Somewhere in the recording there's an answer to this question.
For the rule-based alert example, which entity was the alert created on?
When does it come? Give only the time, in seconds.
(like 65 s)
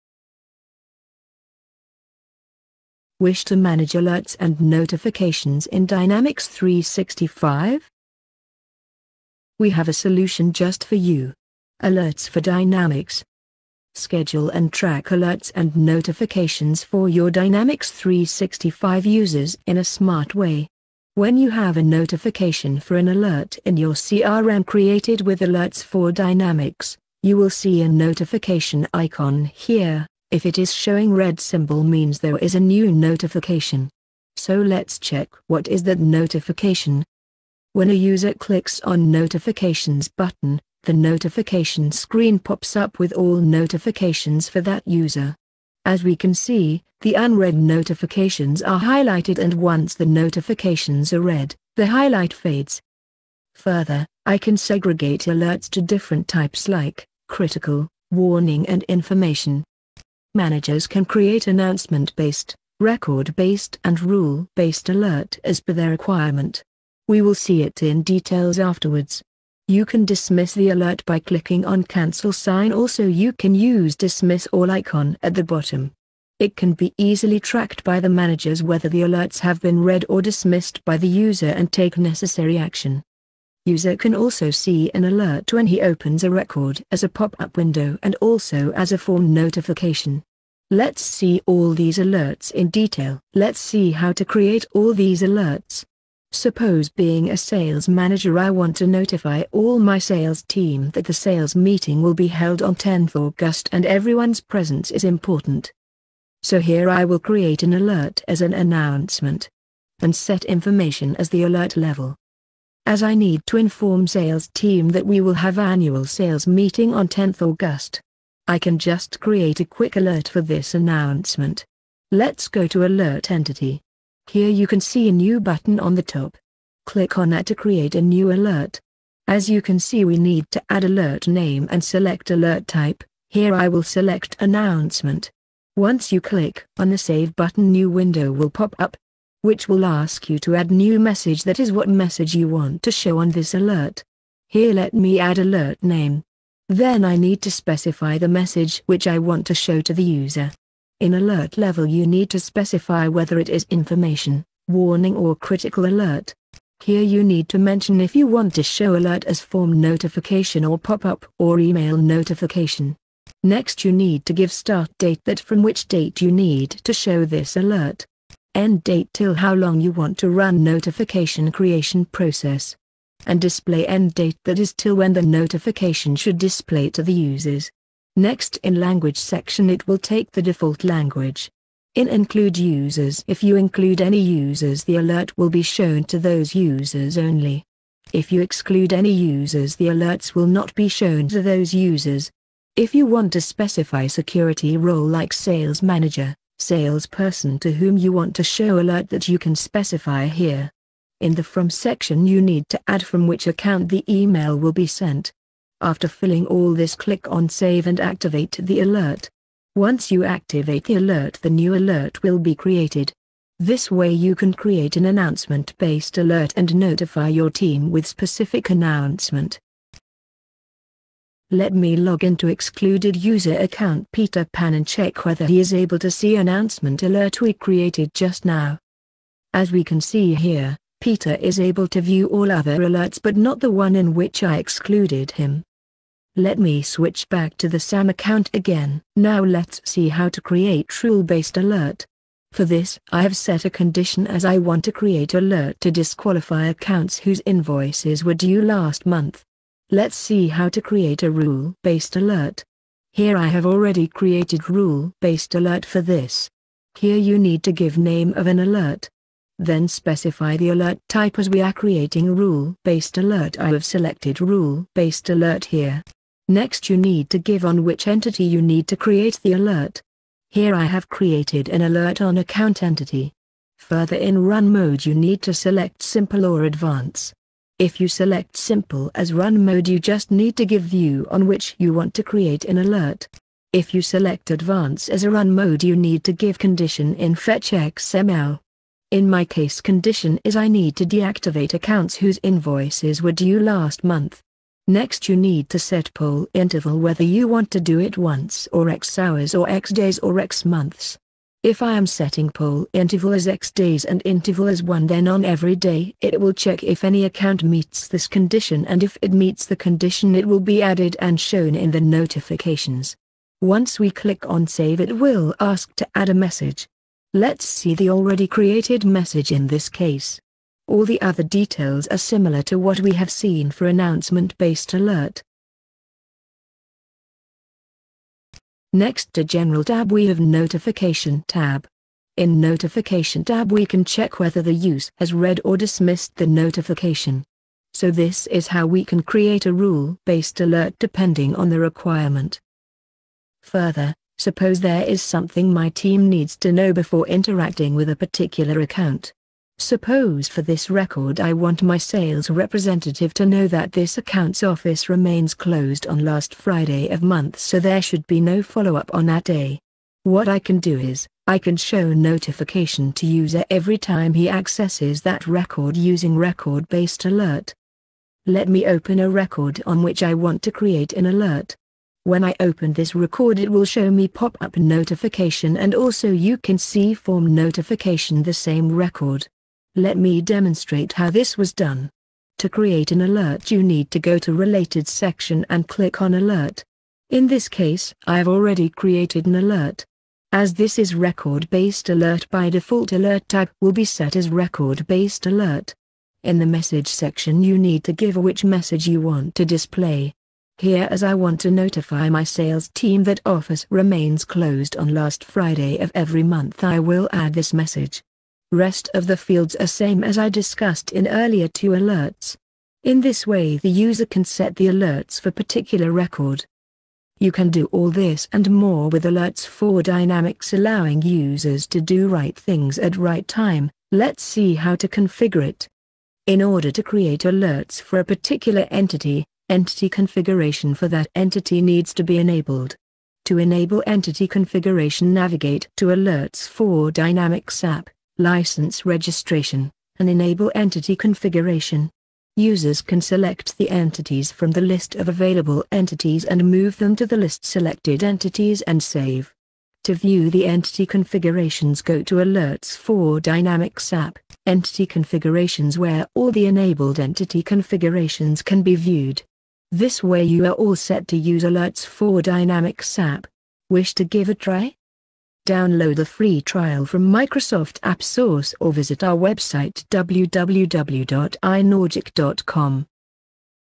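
272 s.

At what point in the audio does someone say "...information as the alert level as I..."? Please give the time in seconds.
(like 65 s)
110 s.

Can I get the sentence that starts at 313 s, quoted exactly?
Once we click on save it will ask to add a message.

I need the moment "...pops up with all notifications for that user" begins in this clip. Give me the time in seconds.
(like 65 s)
42 s.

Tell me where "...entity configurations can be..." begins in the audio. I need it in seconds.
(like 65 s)
457 s.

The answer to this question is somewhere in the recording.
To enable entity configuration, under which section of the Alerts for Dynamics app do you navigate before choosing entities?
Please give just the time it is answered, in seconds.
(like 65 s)
438 s.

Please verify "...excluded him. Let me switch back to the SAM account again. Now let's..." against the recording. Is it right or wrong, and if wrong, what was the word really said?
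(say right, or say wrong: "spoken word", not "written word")
right.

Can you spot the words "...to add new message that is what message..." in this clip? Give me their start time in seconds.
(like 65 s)
140 s.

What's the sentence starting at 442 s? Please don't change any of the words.
Users can select the entities from the list of available entities and move them to the list selected entities and save.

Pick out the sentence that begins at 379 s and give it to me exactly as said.
Let me demonstrate how this was done.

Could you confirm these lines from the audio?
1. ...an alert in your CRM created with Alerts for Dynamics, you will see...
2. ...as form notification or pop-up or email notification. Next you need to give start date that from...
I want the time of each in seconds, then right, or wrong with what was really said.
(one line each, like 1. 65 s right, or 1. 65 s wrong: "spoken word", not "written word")
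1. 22 s right
2. 159 s right.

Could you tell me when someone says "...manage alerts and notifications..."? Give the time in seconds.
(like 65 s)
3 s.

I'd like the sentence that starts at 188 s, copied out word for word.
If you exclude any users the alerts will not be shown to those users.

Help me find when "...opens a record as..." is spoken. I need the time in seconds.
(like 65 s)
85 s.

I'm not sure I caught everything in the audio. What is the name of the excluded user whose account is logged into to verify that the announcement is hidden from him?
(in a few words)
Peter Pan.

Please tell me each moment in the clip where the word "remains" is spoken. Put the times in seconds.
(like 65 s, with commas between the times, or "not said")
355 s, 403 s.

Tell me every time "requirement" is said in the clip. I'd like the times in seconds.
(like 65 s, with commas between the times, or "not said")
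65 s, 341 s.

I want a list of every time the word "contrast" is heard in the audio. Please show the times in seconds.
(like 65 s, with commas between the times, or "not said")
not said.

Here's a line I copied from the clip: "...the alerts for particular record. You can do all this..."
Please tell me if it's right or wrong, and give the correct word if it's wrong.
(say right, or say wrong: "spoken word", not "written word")
right.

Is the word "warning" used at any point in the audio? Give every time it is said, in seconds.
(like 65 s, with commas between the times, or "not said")
58 s, 154 s.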